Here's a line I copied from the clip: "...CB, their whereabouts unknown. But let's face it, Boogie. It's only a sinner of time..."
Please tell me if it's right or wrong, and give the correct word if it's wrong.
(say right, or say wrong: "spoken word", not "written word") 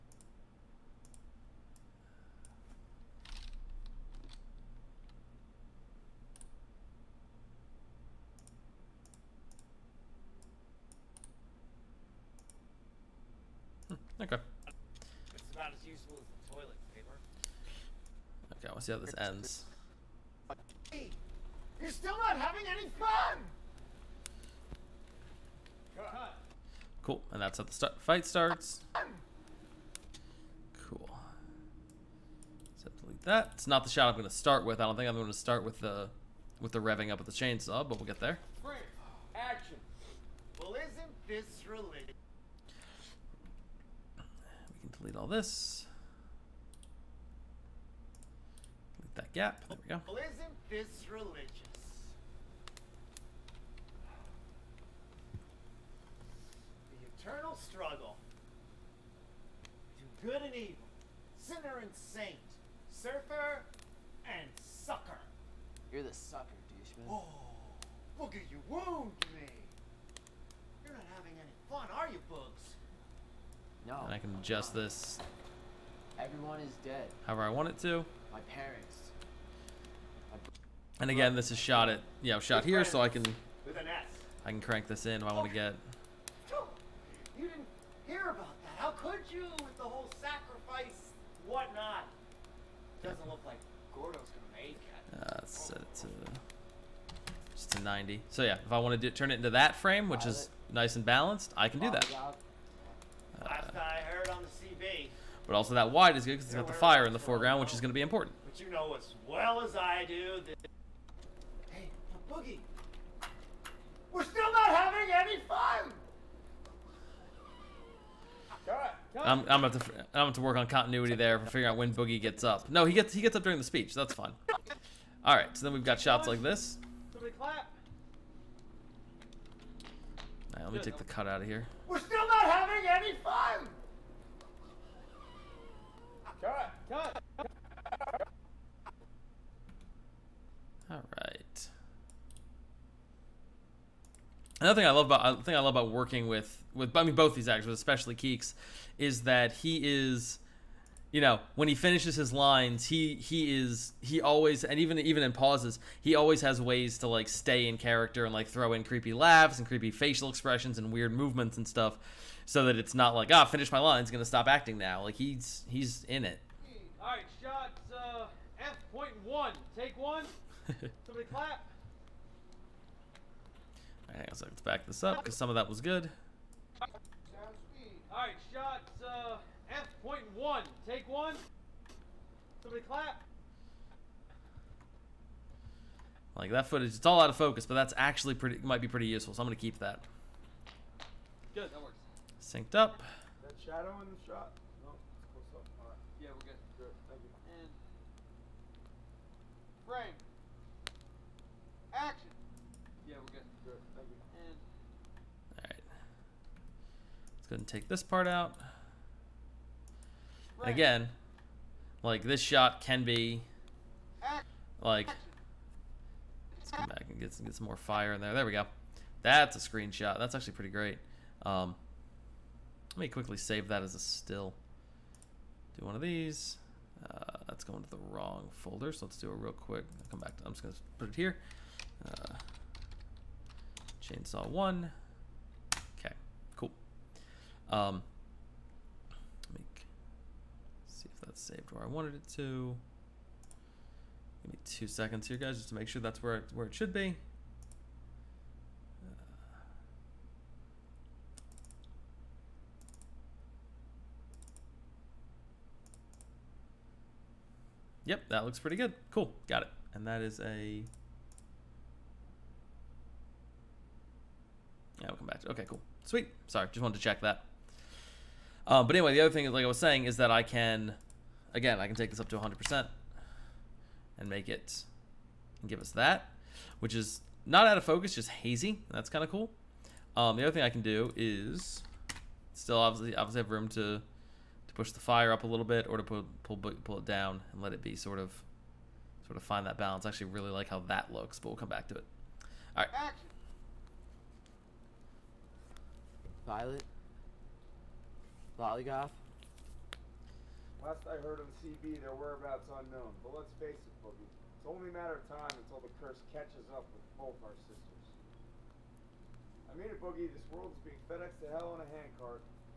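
wrong: "matter", not "sinner".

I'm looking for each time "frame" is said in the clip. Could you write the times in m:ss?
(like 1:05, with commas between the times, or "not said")
1:39, 3:19.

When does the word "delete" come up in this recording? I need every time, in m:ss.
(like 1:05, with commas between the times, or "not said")
0:33, 0:44.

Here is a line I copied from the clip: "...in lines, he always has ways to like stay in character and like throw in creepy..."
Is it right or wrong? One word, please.
wrong.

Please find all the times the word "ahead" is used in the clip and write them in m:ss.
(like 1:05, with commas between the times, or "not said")
3:27.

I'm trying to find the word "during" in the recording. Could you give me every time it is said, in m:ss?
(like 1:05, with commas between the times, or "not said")
2:03.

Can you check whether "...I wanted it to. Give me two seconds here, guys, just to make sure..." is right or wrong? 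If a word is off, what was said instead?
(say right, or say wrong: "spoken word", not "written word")
right.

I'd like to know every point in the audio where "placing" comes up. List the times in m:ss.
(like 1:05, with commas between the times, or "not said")
not said.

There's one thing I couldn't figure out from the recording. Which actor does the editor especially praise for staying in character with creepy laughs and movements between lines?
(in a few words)
Keeks.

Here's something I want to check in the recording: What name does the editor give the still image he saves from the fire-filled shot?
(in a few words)
chainsaw 1.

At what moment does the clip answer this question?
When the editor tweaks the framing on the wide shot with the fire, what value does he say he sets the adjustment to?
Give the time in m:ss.
1:37.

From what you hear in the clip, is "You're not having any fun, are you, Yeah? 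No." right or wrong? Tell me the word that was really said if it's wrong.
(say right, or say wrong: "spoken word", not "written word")
wrong: "Bugs", not "Yeah".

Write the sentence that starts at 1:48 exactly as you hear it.
But you know as well as I do that Boogie, we're still not having any fun.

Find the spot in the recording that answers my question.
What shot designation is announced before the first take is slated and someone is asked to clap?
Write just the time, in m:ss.
2:59.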